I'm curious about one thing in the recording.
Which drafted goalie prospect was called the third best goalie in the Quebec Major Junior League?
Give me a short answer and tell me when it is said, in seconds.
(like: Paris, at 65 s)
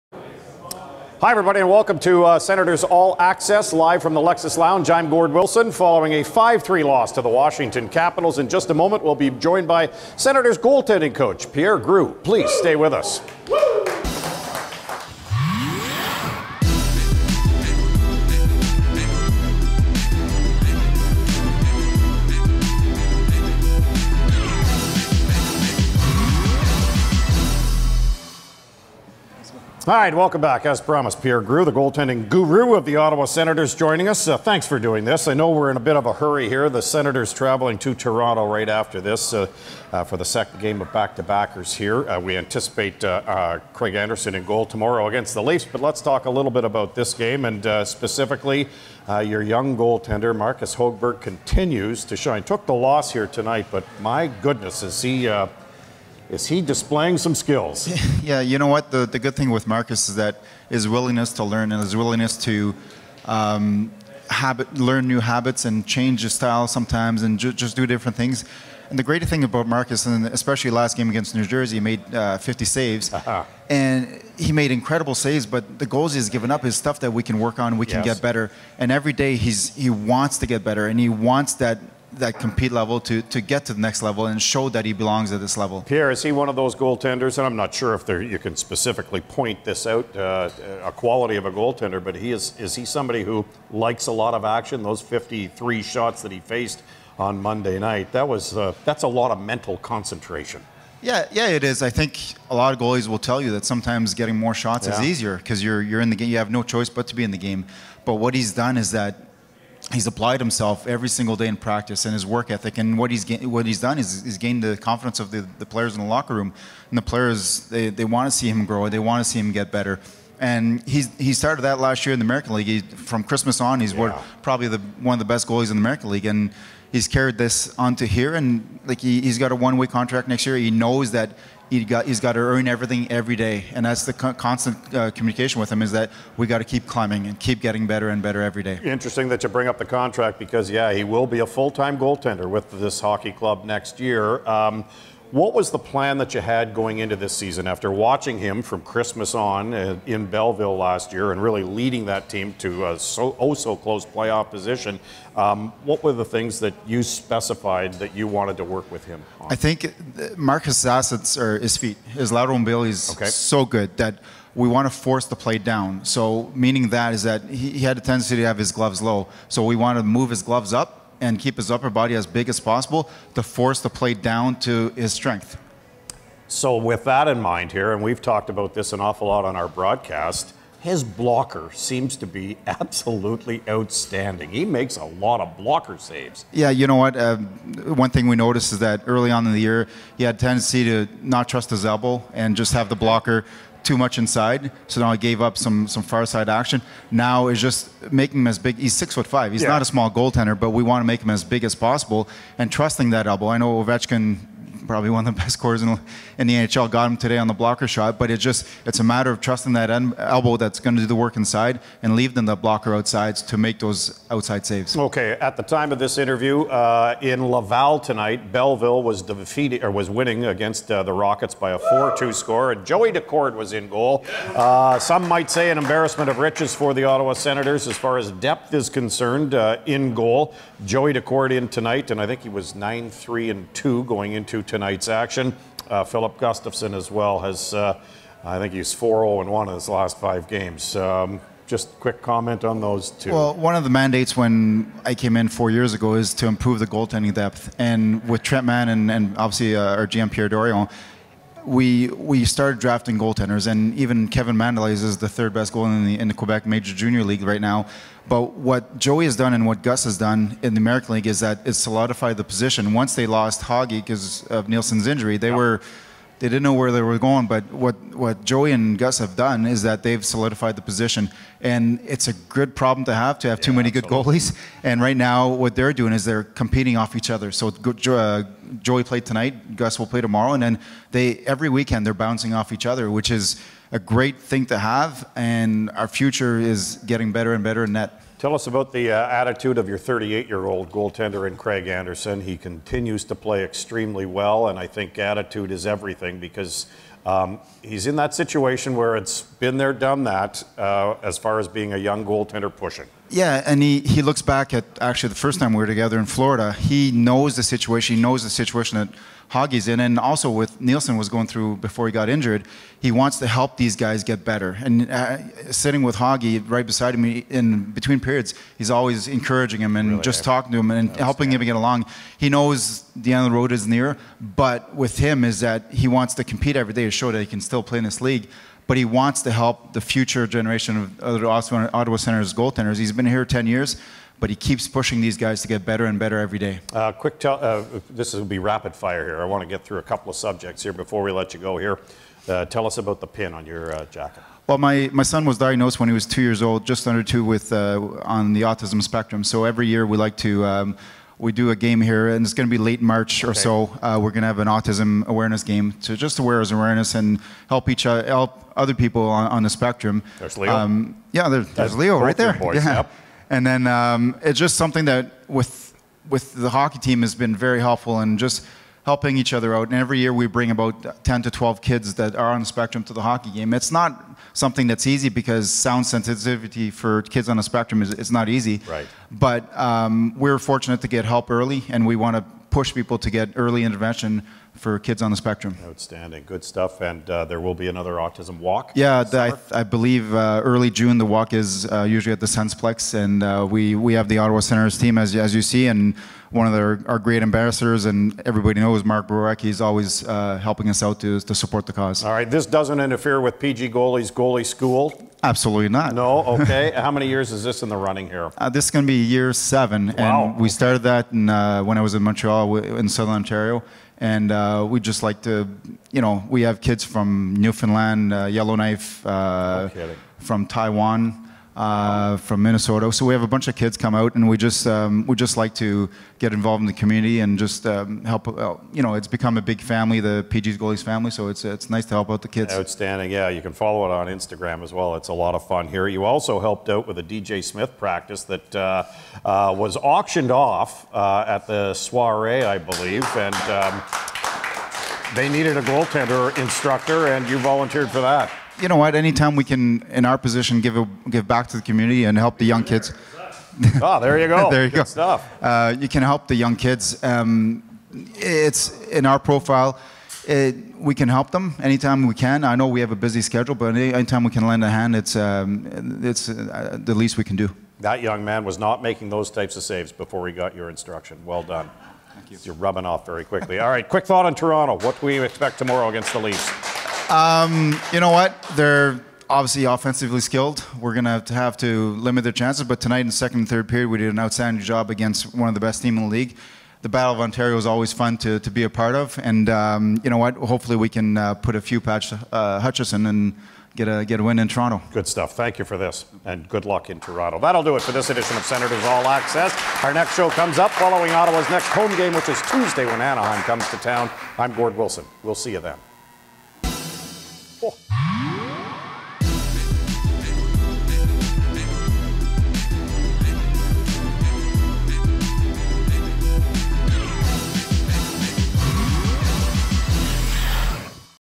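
Kevin Mandolese, at 254 s.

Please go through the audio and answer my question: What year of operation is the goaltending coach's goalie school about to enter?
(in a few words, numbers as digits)
7.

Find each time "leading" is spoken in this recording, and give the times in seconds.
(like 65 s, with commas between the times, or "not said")
151 s.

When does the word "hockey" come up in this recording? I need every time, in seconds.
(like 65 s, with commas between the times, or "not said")
142 s, 366 s, 373 s.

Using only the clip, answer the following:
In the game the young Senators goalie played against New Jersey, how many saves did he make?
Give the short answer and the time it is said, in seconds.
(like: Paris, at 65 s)
50, at 72 s.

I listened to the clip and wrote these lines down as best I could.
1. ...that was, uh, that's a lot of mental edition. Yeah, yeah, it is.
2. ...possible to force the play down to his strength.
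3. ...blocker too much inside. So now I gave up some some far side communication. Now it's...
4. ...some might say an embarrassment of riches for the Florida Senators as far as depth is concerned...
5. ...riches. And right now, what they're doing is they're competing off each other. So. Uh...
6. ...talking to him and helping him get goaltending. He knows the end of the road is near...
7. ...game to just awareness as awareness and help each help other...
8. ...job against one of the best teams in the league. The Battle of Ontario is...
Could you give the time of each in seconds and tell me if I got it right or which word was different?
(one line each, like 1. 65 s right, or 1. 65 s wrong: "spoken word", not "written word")
1. 98 s wrong: "concentration", not "edition"
2. 172 s right
3. 192 s wrong: "action", not "communication"
4. 224 s wrong: "Ottawa", not "Florida"
5. 274 s wrong: "goalies", not "riches"
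6. 320 s wrong: "along", not "goaltending"
7. 355 s right
8. 484 s right.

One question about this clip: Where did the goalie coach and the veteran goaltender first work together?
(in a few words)
Florida.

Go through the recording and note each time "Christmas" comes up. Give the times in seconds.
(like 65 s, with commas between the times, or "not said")
123 s, 148 s.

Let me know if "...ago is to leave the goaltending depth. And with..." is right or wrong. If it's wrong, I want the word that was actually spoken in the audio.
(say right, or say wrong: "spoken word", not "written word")
wrong: "improve", not "leave".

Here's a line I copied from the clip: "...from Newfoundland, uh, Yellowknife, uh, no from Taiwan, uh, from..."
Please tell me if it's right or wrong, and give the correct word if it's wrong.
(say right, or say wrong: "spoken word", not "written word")
right.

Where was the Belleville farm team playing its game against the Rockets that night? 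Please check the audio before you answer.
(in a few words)
Laval.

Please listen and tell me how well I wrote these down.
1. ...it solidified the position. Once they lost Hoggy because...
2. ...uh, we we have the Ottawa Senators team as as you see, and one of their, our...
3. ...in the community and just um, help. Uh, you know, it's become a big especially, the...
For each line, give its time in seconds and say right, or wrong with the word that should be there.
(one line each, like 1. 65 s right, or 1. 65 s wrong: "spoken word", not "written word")
1. 261 s right
2. 393 s right
3. 426 s wrong: "family", not "especially".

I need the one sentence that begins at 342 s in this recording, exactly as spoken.
Uh, tell us about the pin on your uh, jacket.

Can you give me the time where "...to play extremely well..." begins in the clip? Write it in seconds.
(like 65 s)
293 s.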